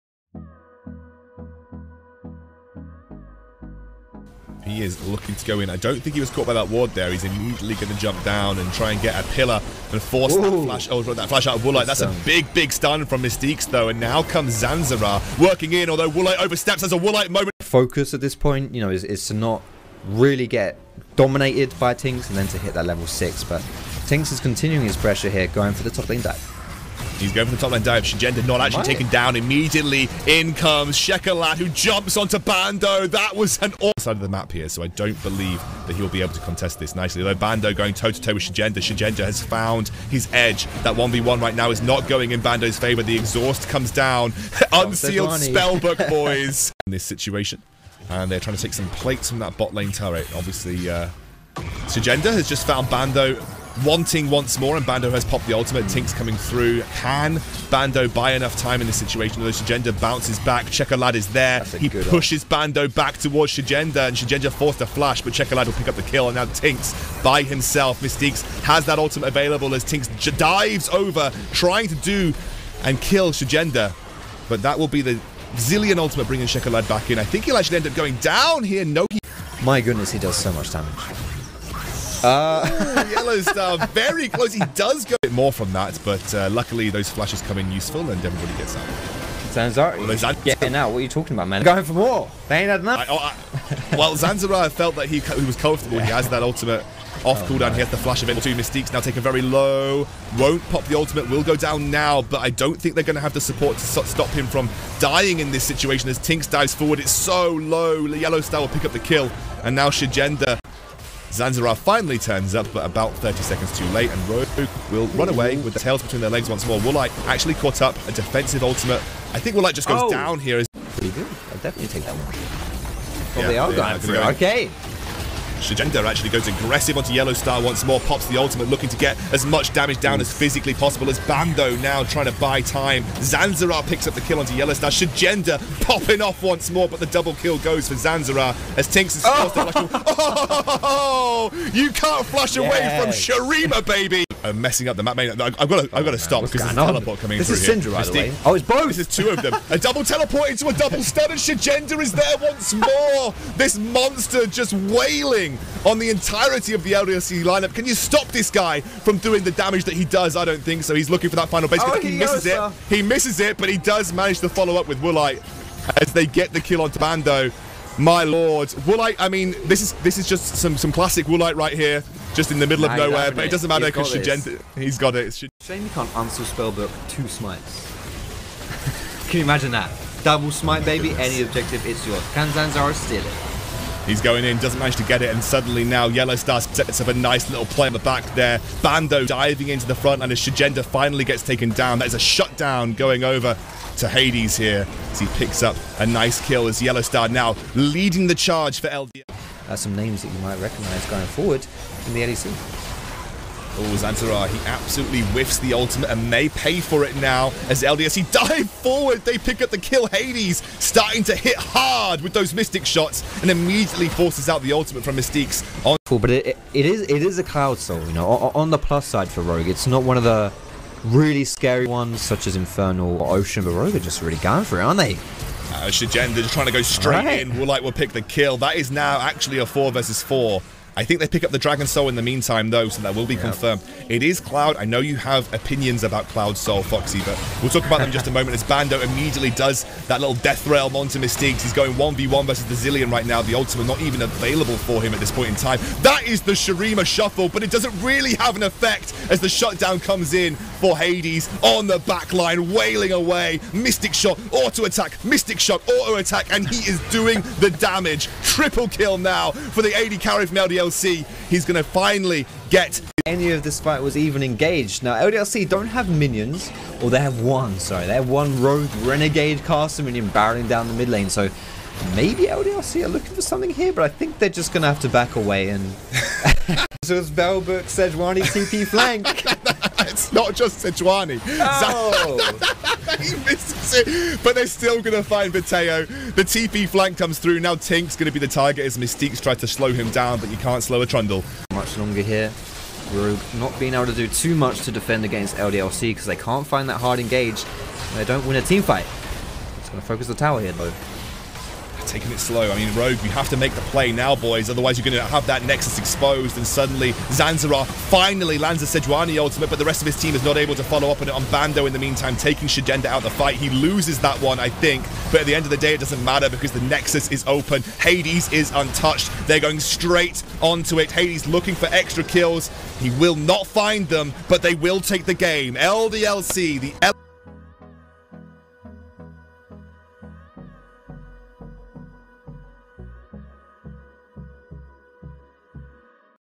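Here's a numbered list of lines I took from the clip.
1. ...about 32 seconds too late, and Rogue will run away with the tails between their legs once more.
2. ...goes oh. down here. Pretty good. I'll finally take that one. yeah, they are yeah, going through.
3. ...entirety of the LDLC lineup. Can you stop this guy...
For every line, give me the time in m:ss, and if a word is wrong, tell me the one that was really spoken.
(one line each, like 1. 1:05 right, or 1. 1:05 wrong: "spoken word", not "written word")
1. 1:52 wrong: "30", not "32"
2. 1:59 wrong: "definitely", not "finally"
3. 2:36 right.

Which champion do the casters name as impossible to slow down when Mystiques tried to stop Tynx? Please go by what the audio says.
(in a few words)
Trundle.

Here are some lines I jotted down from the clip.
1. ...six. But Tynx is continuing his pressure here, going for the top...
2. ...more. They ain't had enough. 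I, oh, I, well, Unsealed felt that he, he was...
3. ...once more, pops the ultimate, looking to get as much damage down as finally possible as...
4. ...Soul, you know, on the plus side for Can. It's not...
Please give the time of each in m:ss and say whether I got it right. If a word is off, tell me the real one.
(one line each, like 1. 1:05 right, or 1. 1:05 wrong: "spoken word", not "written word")
1. 0:23 right
2. 1:31 wrong: "Zanzarah", not "Unsealed"
3. 2:07 wrong: "physically", not "finally"
4. 3:37 wrong: "Rogue", not "Can".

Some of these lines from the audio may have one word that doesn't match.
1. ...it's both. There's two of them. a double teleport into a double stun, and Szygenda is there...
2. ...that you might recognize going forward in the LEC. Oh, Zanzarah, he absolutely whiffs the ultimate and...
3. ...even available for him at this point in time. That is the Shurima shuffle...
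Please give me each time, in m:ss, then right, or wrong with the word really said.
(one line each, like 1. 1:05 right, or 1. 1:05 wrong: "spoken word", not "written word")
1. 2:28 right
2. 3:20 right
3. 4:04 right.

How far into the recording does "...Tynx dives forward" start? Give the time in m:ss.
1:46.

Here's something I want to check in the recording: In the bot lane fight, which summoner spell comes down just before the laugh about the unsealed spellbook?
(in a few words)
Exhaust.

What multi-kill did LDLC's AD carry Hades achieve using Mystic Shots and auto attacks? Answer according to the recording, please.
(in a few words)
Triple kill.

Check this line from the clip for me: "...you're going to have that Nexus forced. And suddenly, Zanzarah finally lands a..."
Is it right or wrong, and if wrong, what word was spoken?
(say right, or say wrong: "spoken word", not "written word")
wrong: "exposed", not "forced".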